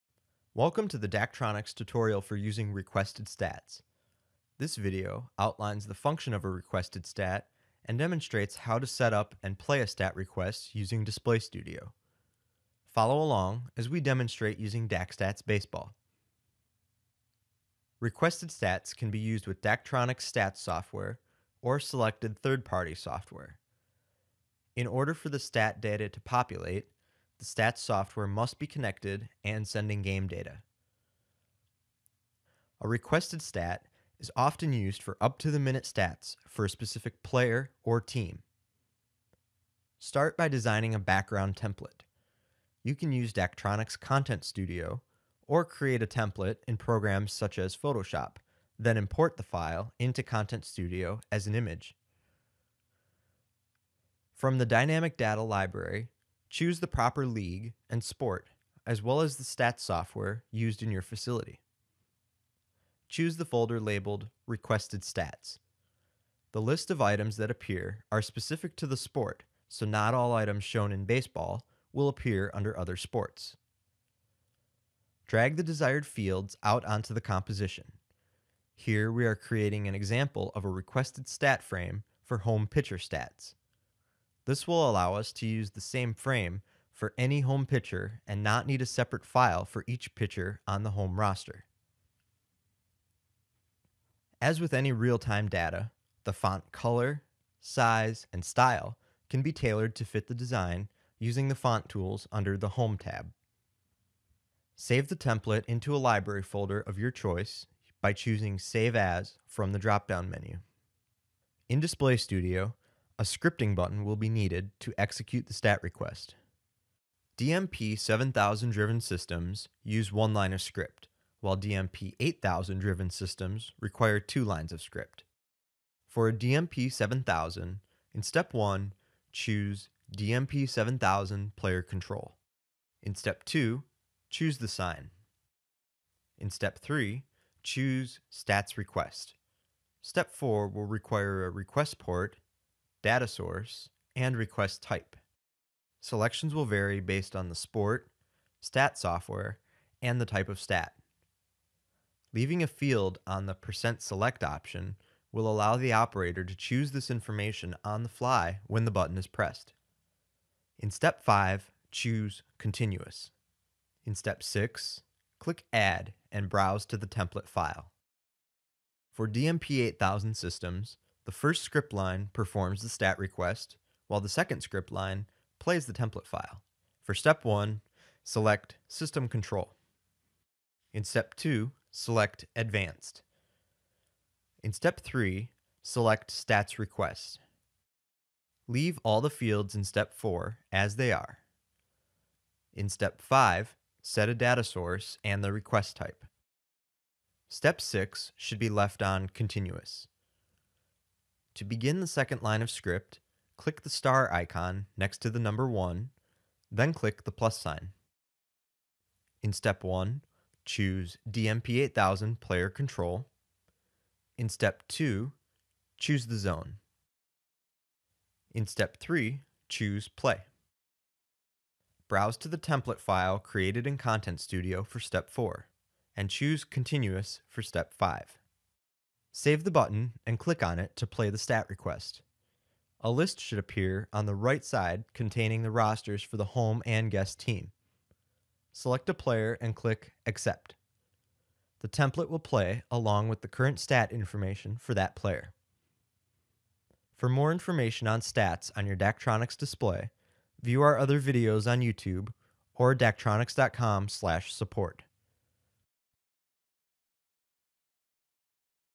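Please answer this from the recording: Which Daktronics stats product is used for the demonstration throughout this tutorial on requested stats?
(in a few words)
DakStats Baseball.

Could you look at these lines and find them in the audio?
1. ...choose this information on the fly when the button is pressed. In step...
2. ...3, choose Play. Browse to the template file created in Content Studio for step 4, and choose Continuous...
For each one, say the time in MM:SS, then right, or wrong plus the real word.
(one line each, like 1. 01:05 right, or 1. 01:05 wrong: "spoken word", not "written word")
1. 02:36 right
2. 03:38 right.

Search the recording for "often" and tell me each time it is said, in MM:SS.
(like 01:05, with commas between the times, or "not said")
00:34.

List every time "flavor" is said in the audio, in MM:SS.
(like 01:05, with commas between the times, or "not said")
not said.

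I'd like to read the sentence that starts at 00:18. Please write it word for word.
Requested stats can be used with Daktronics stats software or selected third-party software.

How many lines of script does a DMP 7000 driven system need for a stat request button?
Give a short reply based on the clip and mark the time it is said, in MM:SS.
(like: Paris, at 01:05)
1, at 02:00.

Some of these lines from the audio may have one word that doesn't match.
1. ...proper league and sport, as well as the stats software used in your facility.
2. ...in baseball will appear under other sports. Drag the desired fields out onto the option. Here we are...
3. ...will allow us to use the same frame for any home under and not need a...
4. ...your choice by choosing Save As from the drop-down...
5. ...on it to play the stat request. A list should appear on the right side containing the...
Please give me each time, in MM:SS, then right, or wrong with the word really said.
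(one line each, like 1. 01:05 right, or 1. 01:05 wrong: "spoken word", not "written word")
1. 00:56 right
2. 01:10 wrong: "composition", not "option"
3. 01:24 wrong: "pitcher", not "under"
4. 01:46 right
5. 03:50 right.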